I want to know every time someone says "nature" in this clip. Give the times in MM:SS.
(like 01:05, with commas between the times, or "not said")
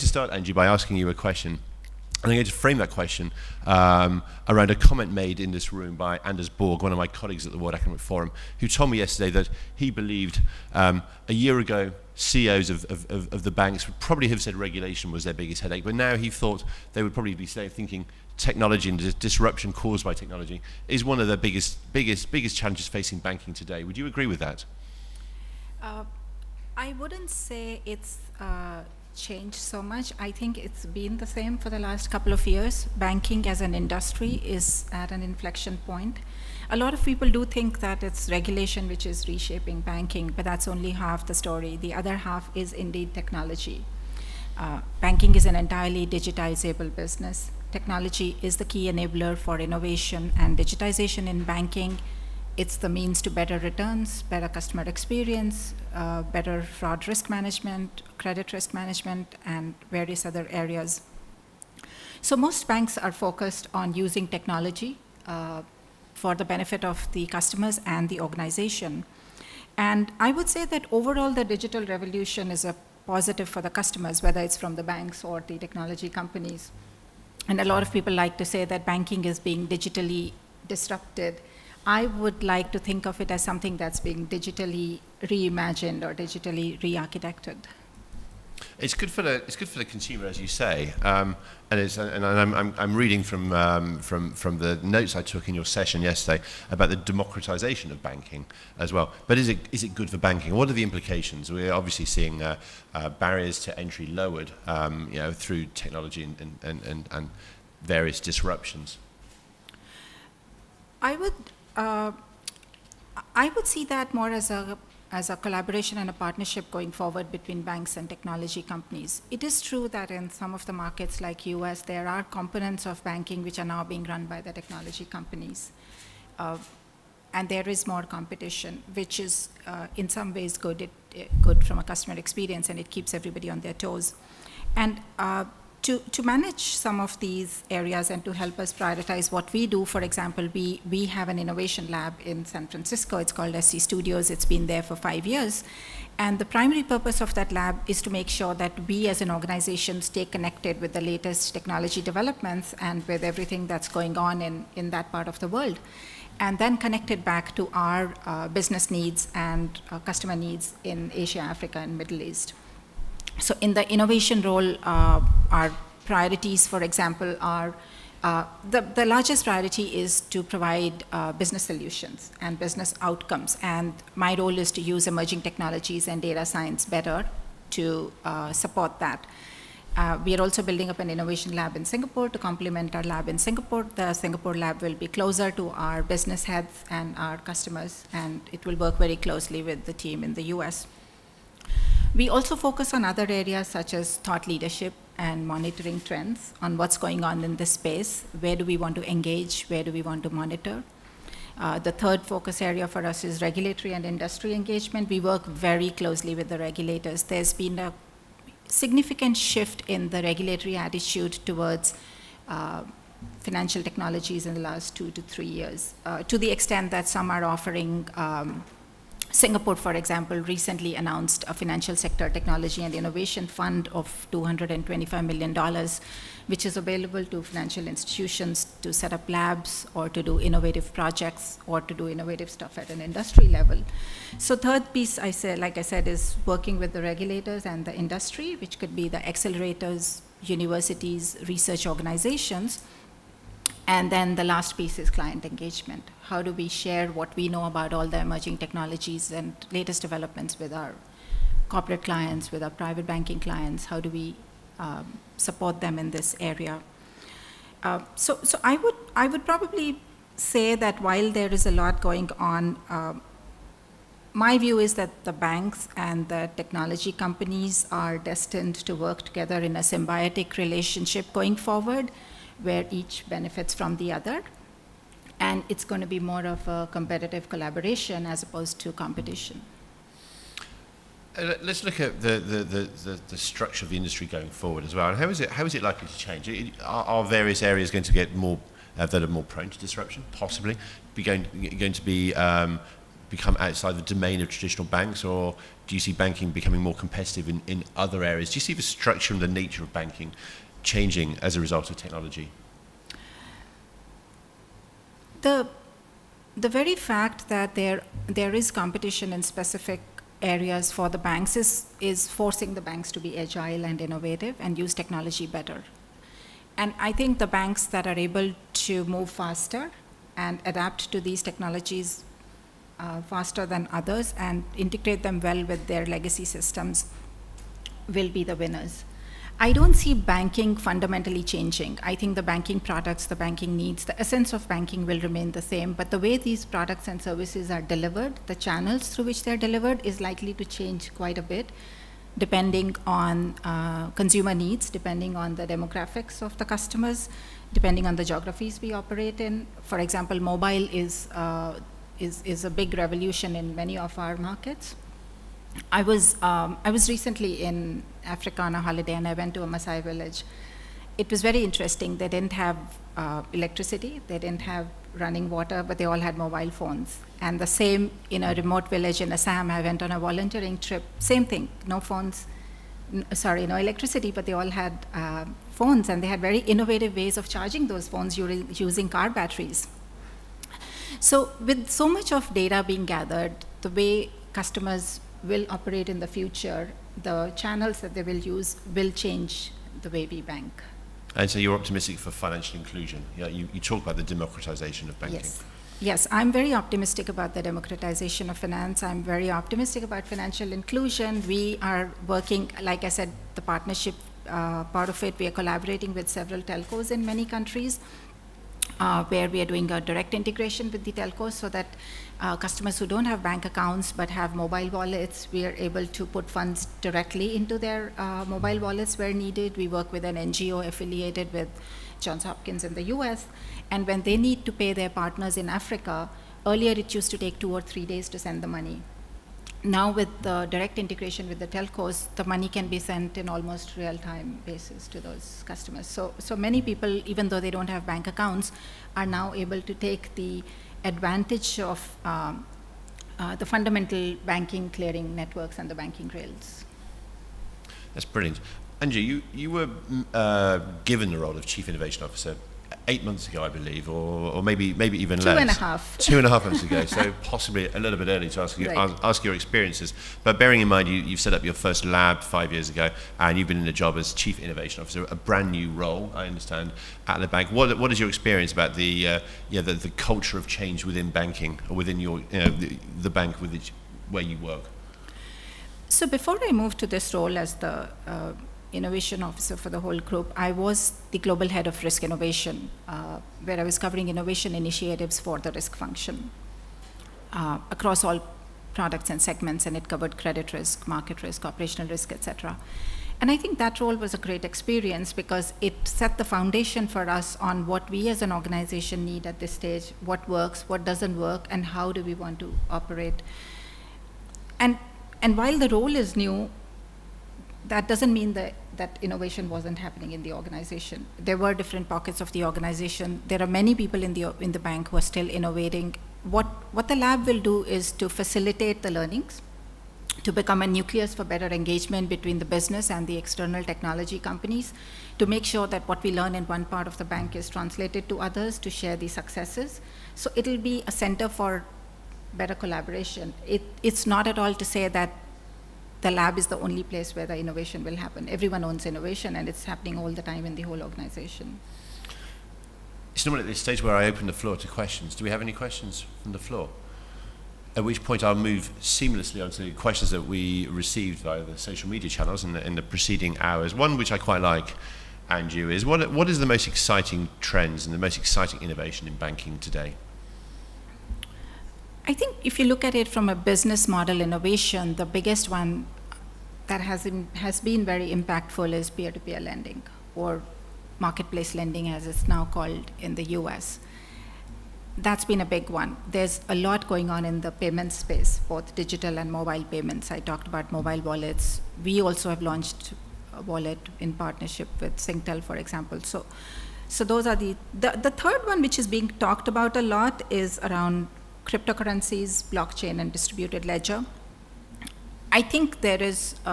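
04:59.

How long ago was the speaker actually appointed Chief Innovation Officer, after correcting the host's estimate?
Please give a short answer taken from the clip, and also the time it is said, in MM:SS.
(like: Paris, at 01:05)
Two and a half months, at 07:36.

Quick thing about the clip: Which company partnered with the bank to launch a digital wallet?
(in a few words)
Singtel.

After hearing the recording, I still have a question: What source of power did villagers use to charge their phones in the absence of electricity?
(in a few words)
Car batteries.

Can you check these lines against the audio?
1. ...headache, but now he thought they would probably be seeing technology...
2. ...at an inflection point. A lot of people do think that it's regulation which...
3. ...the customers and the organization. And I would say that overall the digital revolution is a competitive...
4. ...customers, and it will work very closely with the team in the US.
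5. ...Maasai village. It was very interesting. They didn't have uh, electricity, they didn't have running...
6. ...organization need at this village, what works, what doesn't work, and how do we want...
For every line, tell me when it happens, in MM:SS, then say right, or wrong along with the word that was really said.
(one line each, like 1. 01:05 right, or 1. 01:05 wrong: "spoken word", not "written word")
1. 00:15 wrong: "thinking", not "seeing"
2. 00:34 right
3. 01:07 wrong: "positive", not "competitive"
4. 03:07 right
5. 05:59 right
6. 08:18 wrong: "stage", not "village".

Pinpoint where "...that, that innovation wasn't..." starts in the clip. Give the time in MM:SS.
08:28.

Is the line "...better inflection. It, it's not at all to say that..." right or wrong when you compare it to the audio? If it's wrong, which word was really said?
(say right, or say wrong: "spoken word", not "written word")
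wrong: "collaboration", not "inflection".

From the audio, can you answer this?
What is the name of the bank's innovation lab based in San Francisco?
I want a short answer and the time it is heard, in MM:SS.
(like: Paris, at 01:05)
SC Studios, at 02:23.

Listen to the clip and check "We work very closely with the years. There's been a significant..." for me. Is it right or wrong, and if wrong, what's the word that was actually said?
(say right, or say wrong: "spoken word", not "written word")
wrong: "regulators", not "years".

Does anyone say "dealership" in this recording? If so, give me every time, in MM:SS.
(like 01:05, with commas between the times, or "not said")
not said.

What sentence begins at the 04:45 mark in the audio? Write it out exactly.
And how is it, how is it likely to change?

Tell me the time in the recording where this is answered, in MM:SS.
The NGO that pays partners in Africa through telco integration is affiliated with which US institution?
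07:02.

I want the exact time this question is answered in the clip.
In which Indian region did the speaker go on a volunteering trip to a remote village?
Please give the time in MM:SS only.
06:09.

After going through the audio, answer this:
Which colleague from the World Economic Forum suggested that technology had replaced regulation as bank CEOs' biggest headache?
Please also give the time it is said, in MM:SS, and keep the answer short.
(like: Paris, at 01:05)
Anders Borg, at 00:06.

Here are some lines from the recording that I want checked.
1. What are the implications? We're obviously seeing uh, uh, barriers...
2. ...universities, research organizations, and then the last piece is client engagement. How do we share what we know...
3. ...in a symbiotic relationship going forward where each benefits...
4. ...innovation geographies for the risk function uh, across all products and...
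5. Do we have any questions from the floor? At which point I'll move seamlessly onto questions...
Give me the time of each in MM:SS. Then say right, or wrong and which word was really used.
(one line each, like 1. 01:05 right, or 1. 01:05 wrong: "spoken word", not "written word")
1. 01:40 right
2. 04:00 right
3. 04:29 right
4. 08:04 wrong: "initiatives", not "geographies"
5. 09:05 right.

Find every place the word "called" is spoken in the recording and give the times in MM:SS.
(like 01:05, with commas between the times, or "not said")
02:23, 09:32.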